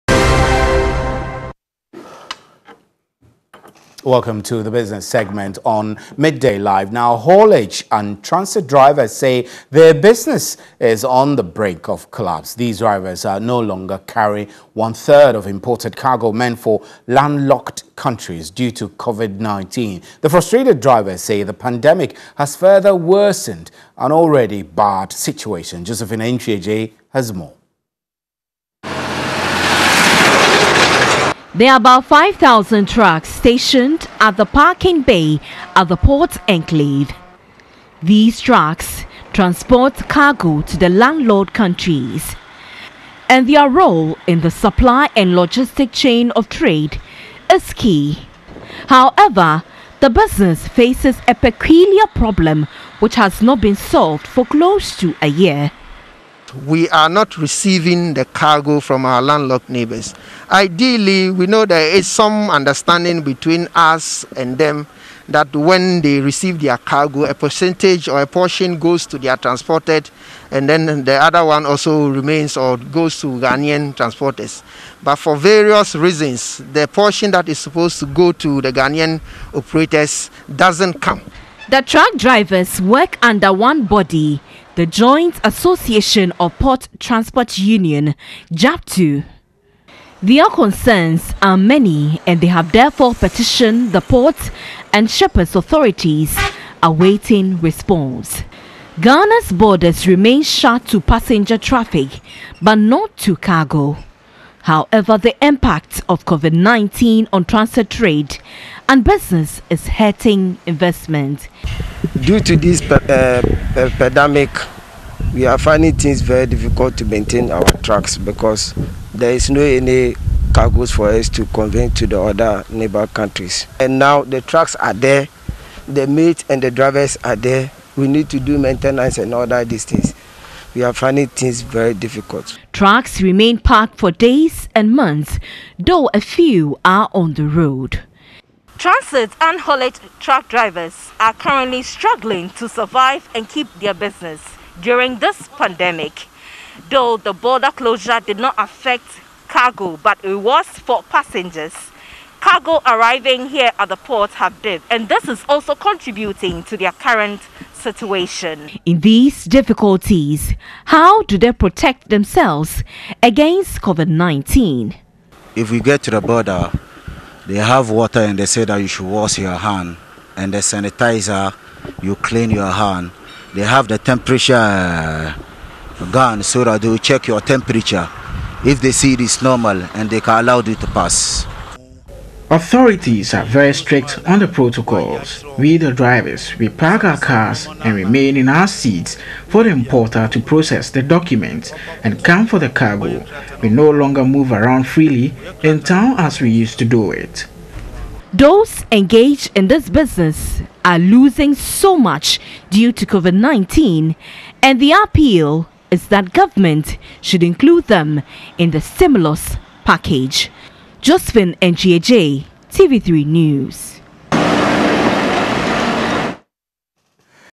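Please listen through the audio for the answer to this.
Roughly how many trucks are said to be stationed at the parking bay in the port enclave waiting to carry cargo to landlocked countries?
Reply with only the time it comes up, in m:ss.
0:32.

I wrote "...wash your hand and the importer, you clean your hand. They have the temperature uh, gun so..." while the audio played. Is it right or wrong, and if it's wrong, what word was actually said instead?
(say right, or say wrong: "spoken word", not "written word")
wrong: "sanitizer", not "importer".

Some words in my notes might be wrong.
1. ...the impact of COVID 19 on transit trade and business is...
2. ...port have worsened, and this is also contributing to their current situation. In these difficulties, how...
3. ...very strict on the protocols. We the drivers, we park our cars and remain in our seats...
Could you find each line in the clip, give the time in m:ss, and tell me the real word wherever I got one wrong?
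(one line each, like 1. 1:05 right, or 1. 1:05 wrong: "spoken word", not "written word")
1. 1:45 right
2. 2:33 wrong: "dipped", not "worsened"
3. 3:03 right.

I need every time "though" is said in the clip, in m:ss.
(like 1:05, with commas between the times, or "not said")
2:15, 2:26.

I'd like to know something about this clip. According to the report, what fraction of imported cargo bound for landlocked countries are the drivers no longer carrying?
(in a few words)
One-third.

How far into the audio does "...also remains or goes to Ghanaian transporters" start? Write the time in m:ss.
1:11.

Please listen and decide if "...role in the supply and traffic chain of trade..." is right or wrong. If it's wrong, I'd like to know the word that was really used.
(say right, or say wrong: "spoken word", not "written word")
wrong: "logistic", not "traffic".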